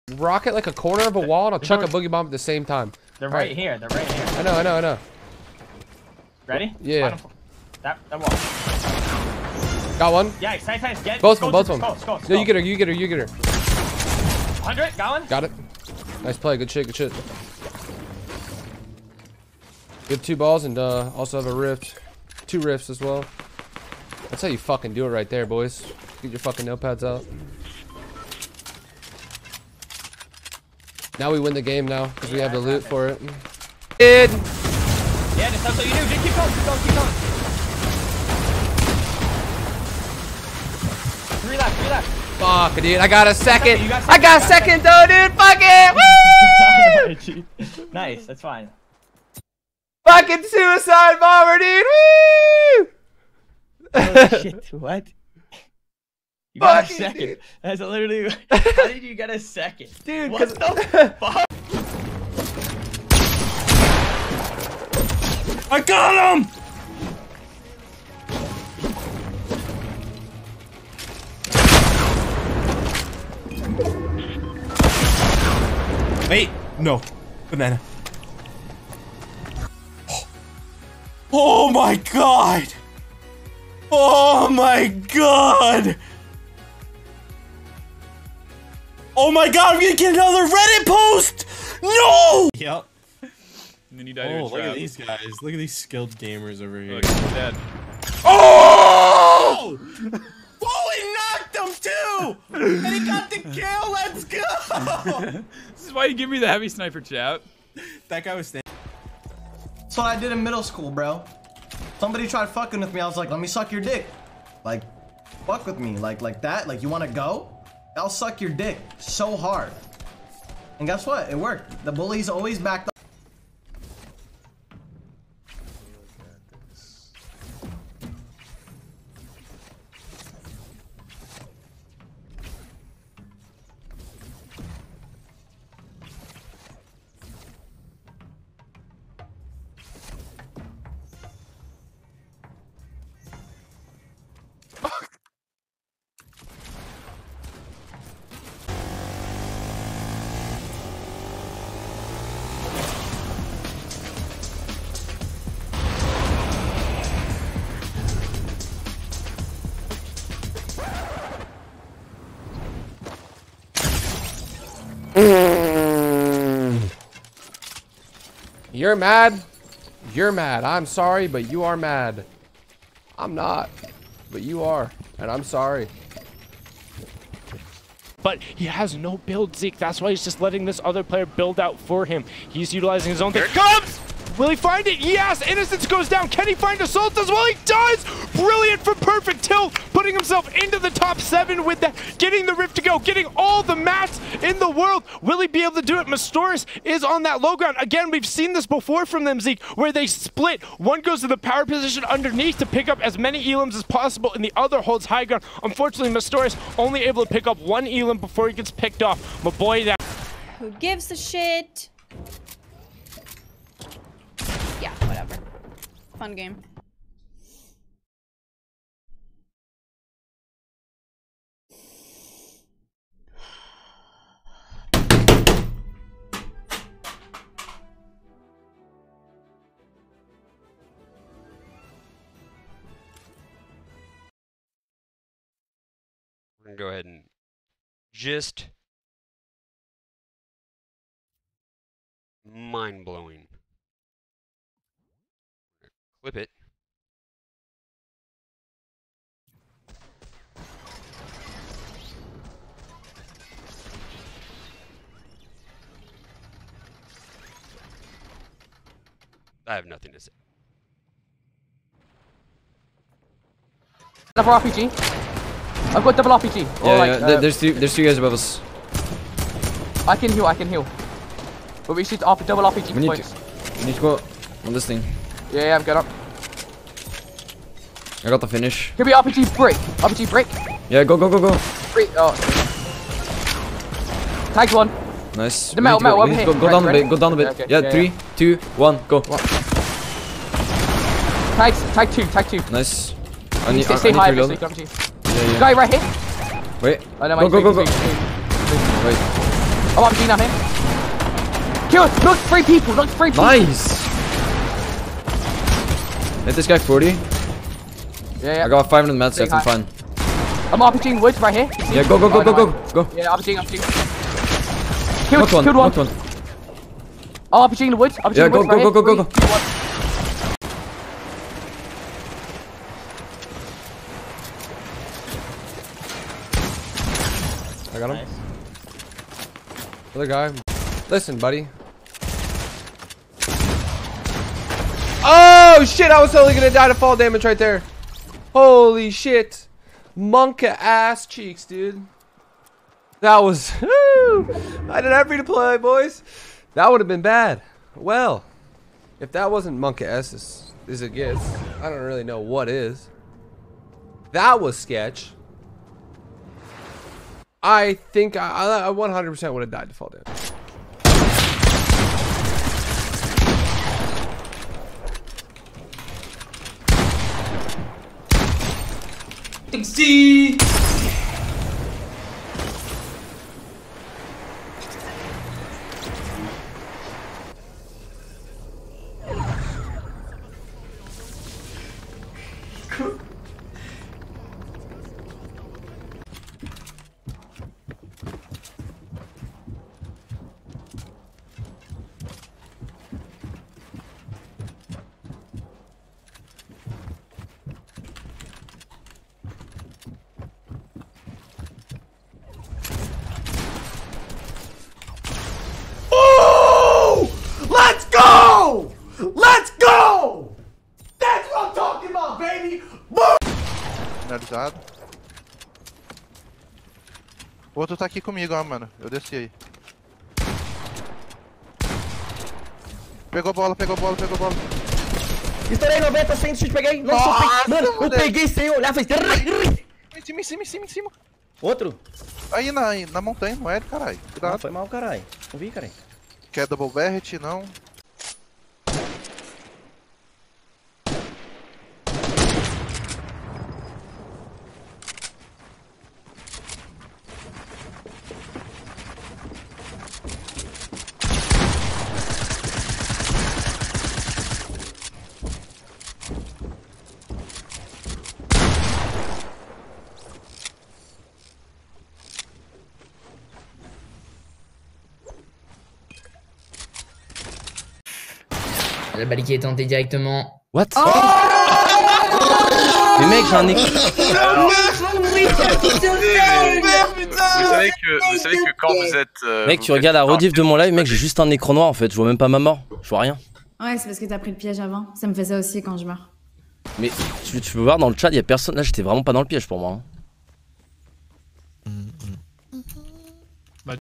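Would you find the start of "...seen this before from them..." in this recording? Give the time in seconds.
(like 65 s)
198 s.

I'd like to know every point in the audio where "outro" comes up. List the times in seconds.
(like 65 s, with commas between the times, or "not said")
417 s, 431 s.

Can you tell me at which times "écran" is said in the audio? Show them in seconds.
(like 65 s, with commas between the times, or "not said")
473 s, 481 s.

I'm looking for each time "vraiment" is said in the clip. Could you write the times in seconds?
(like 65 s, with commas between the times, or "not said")
489 s.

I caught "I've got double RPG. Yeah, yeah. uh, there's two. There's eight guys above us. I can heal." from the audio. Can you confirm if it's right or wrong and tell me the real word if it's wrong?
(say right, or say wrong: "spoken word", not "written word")
wrong: "two", not "eight".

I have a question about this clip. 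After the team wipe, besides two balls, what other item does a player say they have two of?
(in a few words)
Rifts.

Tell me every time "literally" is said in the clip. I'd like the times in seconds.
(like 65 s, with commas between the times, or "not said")
57 s.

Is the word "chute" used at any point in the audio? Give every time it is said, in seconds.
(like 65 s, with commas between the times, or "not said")
426 s.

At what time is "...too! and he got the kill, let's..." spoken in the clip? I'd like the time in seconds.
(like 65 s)
101 s.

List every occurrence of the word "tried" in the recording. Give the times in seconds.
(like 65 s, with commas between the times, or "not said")
112 s.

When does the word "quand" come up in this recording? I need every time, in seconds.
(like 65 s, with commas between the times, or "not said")
478 s, 485 s.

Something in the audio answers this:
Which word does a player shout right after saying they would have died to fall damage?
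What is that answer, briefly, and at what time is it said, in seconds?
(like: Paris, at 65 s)
Taxi, at 369 s.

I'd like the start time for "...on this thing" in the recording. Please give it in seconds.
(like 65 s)
274 s.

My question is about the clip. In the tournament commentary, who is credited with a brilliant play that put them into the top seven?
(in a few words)
Perfect Tilt.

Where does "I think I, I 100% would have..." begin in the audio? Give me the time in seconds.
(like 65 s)
357 s.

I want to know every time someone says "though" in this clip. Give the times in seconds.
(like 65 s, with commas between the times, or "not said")
44 s.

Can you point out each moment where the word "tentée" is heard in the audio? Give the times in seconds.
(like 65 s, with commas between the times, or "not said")
469 s.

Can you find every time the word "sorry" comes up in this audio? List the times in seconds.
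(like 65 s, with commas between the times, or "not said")
170 s, 175 s.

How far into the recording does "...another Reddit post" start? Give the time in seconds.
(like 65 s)
90 s.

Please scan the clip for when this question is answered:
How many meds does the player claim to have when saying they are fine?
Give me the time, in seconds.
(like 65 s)
308 s.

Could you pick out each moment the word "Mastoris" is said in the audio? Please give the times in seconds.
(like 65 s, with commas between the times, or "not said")
196 s, 206 s.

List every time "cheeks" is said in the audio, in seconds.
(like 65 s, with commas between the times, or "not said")
341 s.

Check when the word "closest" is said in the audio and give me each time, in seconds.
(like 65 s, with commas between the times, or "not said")
not said.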